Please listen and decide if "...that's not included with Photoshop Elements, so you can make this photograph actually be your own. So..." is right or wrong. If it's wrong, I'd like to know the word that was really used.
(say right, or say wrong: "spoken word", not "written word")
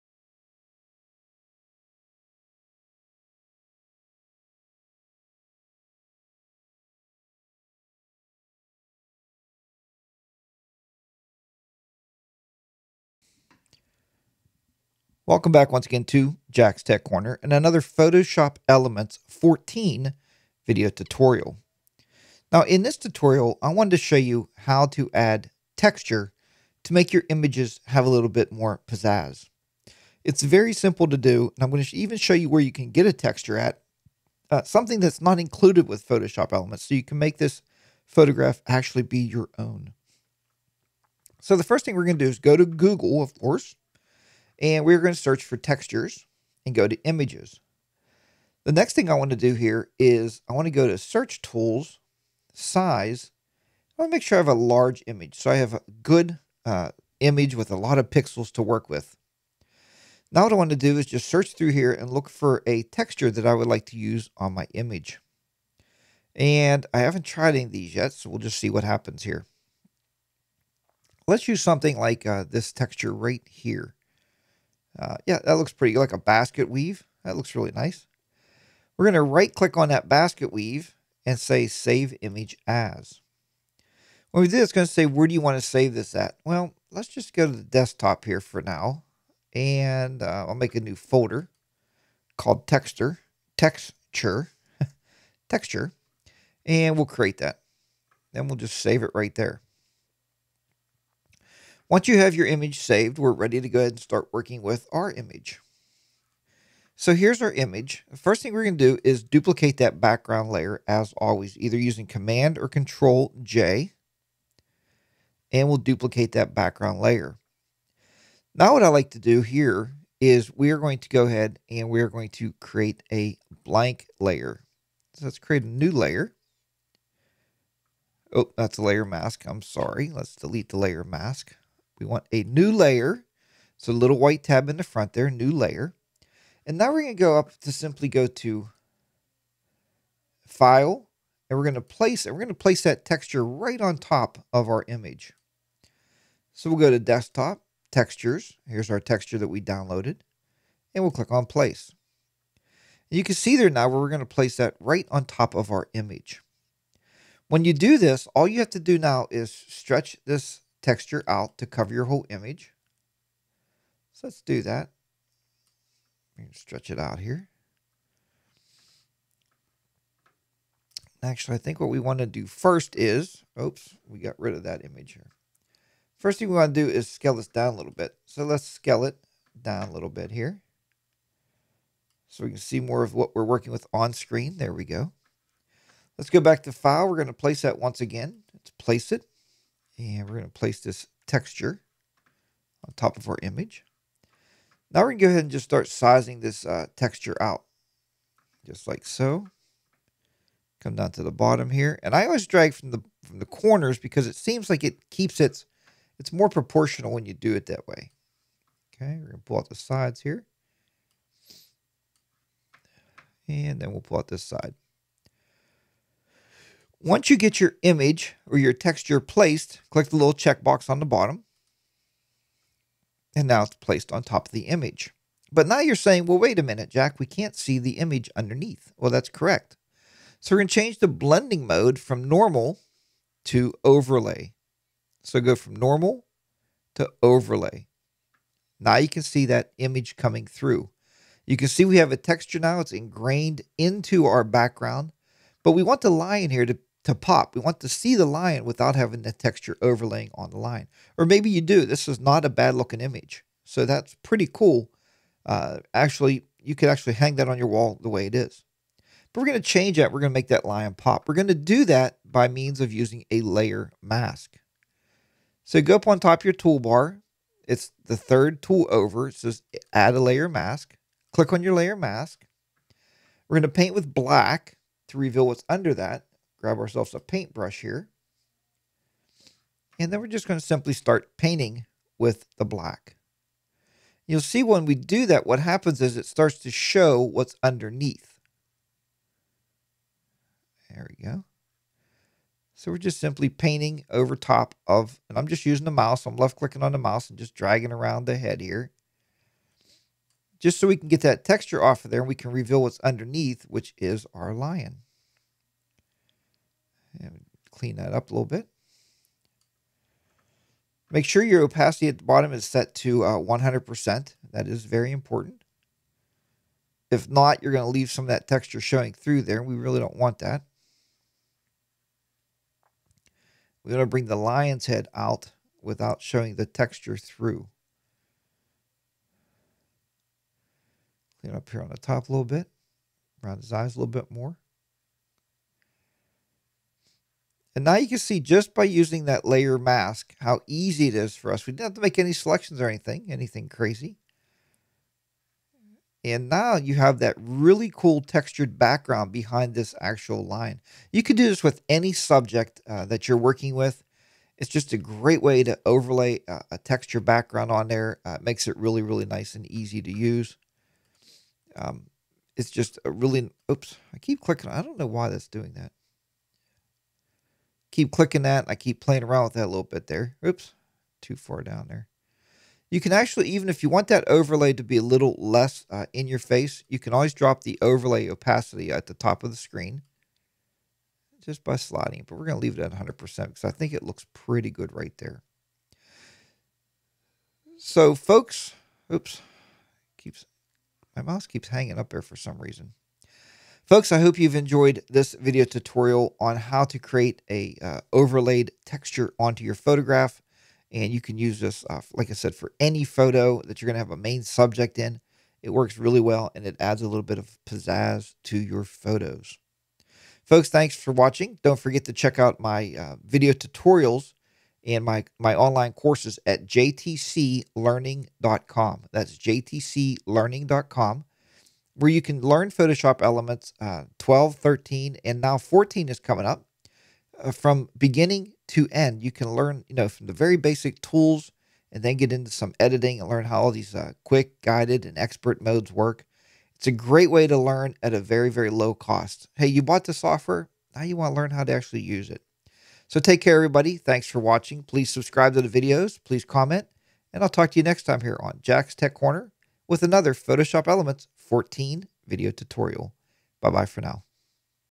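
right.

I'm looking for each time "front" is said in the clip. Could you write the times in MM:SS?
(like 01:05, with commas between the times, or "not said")
02:14.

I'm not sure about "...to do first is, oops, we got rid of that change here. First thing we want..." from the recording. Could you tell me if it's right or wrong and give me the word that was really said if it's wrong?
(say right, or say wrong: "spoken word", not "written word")
wrong: "image", not "change".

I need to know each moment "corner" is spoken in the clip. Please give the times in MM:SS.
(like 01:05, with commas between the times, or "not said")
00:17, 03:23, 07:29.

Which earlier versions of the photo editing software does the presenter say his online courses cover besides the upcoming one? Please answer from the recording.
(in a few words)
12 and 13.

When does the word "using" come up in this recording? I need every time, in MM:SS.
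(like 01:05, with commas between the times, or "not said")
01:51, 04:22, 04:55, 05:38.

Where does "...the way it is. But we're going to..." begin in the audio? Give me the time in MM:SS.
04:18.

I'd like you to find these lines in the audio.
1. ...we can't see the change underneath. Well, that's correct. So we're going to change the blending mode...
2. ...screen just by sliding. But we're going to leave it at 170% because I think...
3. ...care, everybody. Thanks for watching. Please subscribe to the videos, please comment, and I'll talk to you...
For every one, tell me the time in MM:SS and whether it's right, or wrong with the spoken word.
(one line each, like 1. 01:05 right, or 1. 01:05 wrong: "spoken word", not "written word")
1. 03:47 wrong: "image", not "change"
2. 06:19 wrong: "100", not "170"
3. 07:23 right.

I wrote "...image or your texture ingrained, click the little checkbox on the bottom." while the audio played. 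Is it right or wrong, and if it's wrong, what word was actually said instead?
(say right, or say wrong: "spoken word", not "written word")
wrong: "placed", not "ingrained".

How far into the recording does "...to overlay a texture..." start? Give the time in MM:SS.
05:55.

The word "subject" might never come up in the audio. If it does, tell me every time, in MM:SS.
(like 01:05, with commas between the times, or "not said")
05:52, 06:44.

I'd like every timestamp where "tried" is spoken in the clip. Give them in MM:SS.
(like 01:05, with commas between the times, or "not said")
01:07.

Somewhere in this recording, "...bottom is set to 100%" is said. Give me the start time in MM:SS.
05:12.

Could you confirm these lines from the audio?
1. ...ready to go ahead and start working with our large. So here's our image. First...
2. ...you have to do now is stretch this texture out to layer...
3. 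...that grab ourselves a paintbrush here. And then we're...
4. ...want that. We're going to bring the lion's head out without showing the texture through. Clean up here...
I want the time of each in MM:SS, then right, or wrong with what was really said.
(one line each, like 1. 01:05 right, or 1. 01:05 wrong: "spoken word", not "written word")
1. 01:43 wrong: "image", not "large"
2. 02:38 wrong: "cover", not "layer"
3. 04:35 right
4. 05:20 right.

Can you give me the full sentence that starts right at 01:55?
And we'll duplicate that background layer.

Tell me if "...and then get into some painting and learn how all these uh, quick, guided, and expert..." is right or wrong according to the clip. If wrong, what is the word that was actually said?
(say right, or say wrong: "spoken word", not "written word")
wrong: "editing", not "painting".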